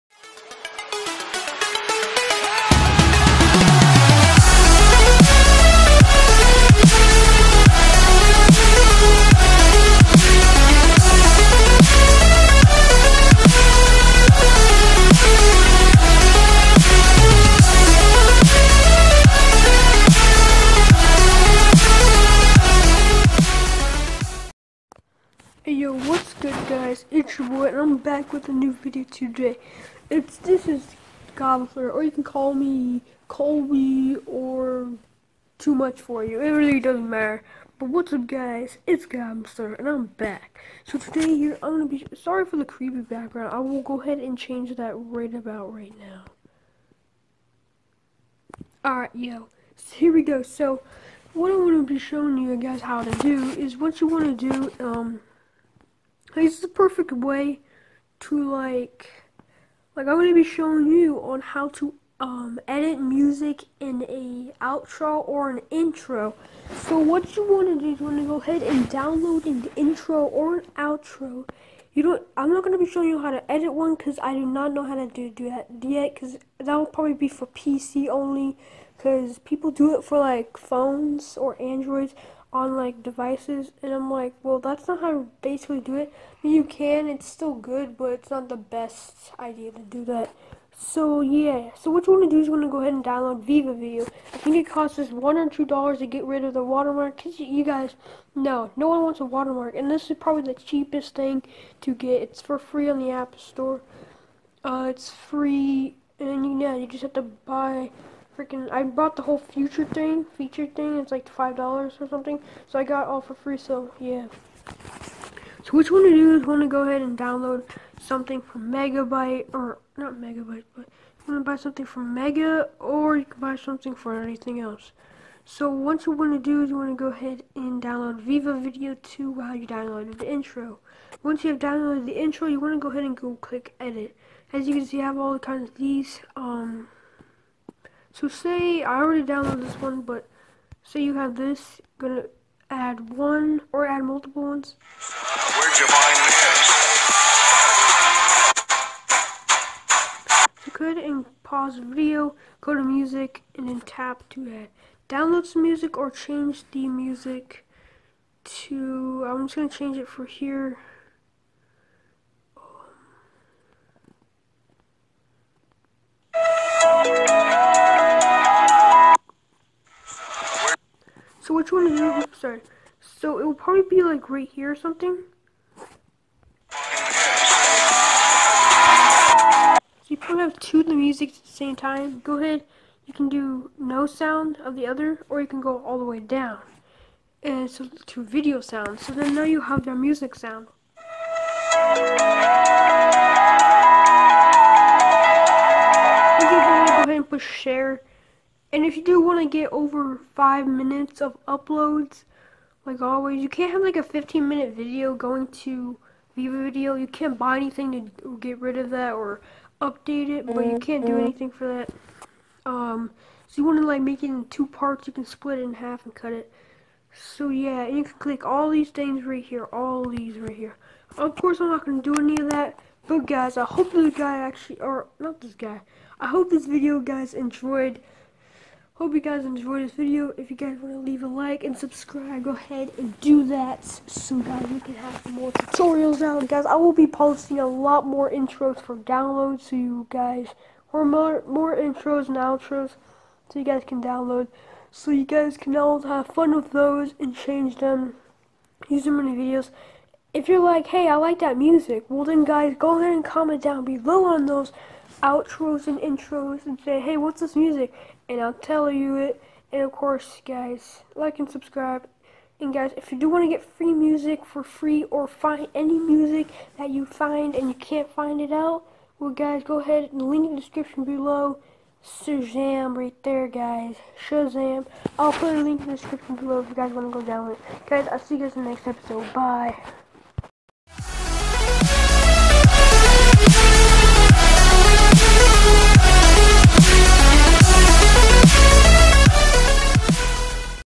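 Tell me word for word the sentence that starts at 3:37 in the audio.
So yeah, you can click all these things right here, all these right here.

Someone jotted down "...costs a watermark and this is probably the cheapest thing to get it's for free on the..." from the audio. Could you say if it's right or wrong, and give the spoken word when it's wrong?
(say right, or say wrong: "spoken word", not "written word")
wrong: "wants", not "costs".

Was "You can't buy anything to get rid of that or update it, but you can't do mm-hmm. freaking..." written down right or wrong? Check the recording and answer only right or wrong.
wrong.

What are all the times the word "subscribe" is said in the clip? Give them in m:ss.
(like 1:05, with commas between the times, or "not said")
3:51, 4:21.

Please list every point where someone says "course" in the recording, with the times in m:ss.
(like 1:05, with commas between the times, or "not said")
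3:41, 4:19.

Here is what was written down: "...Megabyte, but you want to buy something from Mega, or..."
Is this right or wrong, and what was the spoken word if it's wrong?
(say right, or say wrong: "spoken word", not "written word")
right.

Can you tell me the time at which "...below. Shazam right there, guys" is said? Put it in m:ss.
4:31.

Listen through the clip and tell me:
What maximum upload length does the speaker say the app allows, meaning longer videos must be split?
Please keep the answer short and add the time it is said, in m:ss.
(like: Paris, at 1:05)
5 minutes, at 3:20.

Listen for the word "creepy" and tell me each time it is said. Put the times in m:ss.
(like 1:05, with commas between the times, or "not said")
0:42.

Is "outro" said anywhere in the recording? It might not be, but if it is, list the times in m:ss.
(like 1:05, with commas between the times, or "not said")
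1:04, 1:10, 4:02, 4:15.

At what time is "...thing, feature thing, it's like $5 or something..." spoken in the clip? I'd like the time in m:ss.
1:49.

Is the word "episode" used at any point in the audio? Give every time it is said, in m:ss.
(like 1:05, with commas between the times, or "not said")
4:38.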